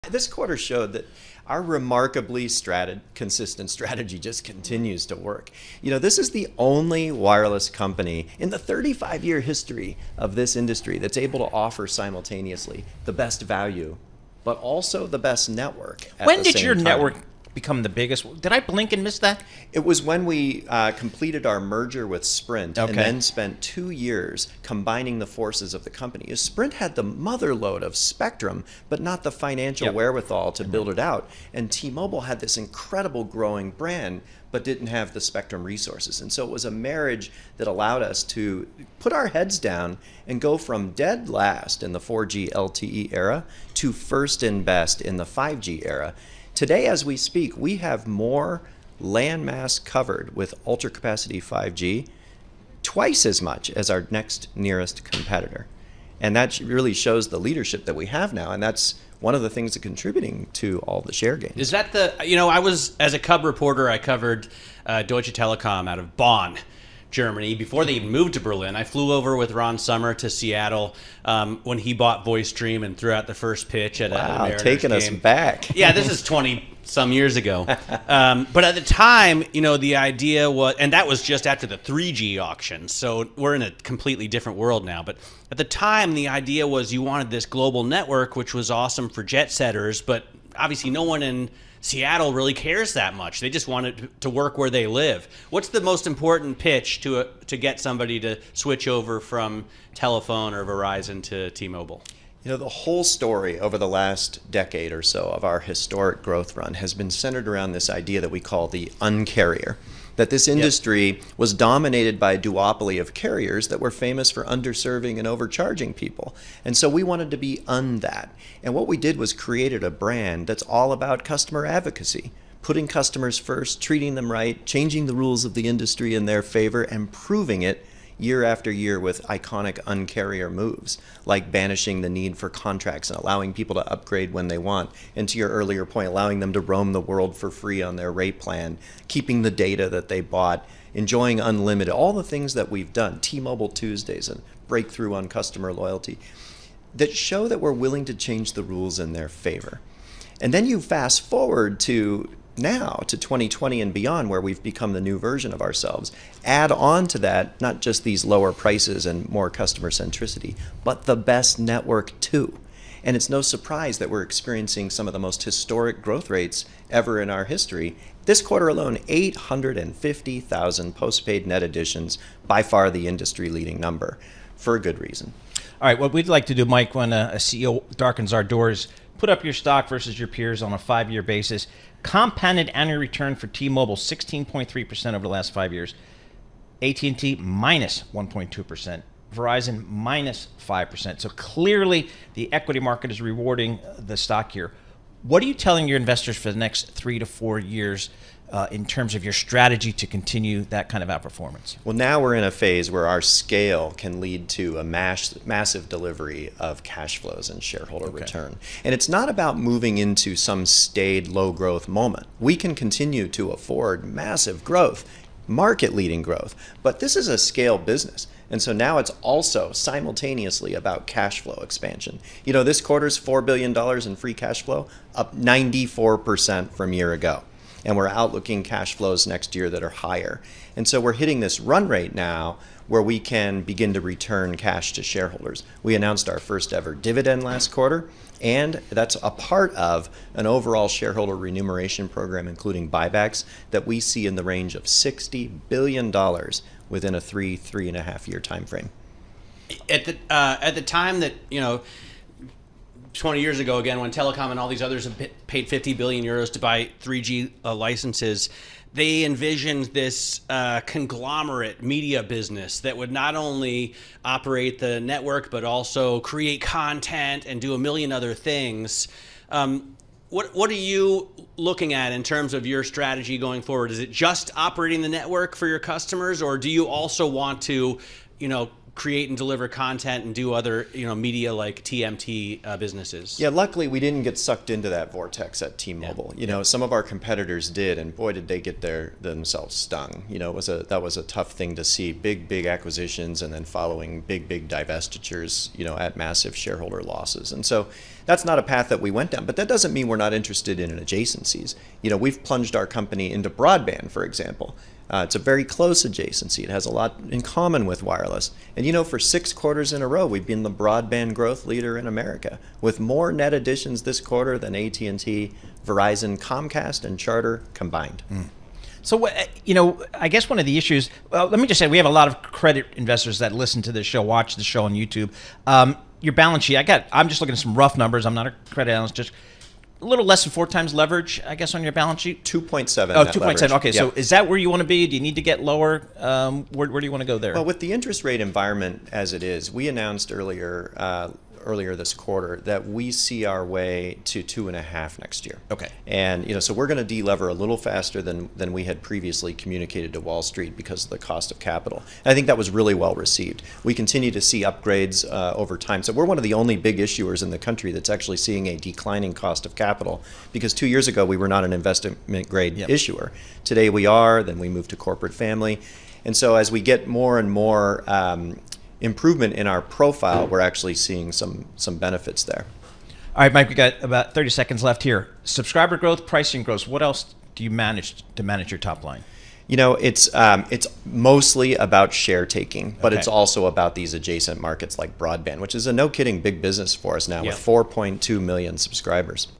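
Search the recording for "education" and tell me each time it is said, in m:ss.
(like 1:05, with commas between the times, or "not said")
not said.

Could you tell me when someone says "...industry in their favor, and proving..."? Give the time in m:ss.
2:05.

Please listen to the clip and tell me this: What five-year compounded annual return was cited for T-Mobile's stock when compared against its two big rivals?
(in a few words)
16.3%.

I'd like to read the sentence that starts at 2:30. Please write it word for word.
And then you fast forward to now to 2020 and beyond, where we've become the new version of ourselves.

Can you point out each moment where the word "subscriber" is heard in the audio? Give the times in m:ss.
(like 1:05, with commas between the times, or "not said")
6:15, 6:28.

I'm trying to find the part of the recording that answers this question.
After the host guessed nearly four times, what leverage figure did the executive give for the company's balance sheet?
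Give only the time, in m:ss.
5:32.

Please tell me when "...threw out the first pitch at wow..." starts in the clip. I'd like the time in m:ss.
1:12.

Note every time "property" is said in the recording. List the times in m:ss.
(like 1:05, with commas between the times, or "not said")
not said.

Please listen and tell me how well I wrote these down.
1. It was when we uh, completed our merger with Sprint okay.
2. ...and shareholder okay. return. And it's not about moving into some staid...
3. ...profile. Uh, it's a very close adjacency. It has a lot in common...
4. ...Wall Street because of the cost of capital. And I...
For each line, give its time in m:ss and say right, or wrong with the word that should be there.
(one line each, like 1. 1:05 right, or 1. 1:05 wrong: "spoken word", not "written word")
1. 0:19 right
2. 3:27 right
3. 5:04 wrong: "example", not "profile"
4. 5:50 right.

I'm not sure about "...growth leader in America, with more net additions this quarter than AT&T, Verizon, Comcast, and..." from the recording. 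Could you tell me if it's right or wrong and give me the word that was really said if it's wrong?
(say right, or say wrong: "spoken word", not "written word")
right.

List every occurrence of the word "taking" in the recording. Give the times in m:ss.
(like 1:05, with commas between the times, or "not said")
1:14, 6:22.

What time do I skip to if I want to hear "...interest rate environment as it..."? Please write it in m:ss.
5:37.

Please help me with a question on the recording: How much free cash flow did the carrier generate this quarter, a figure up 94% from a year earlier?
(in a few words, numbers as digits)
$4 billion.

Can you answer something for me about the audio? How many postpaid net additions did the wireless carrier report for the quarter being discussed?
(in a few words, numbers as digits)
850,000.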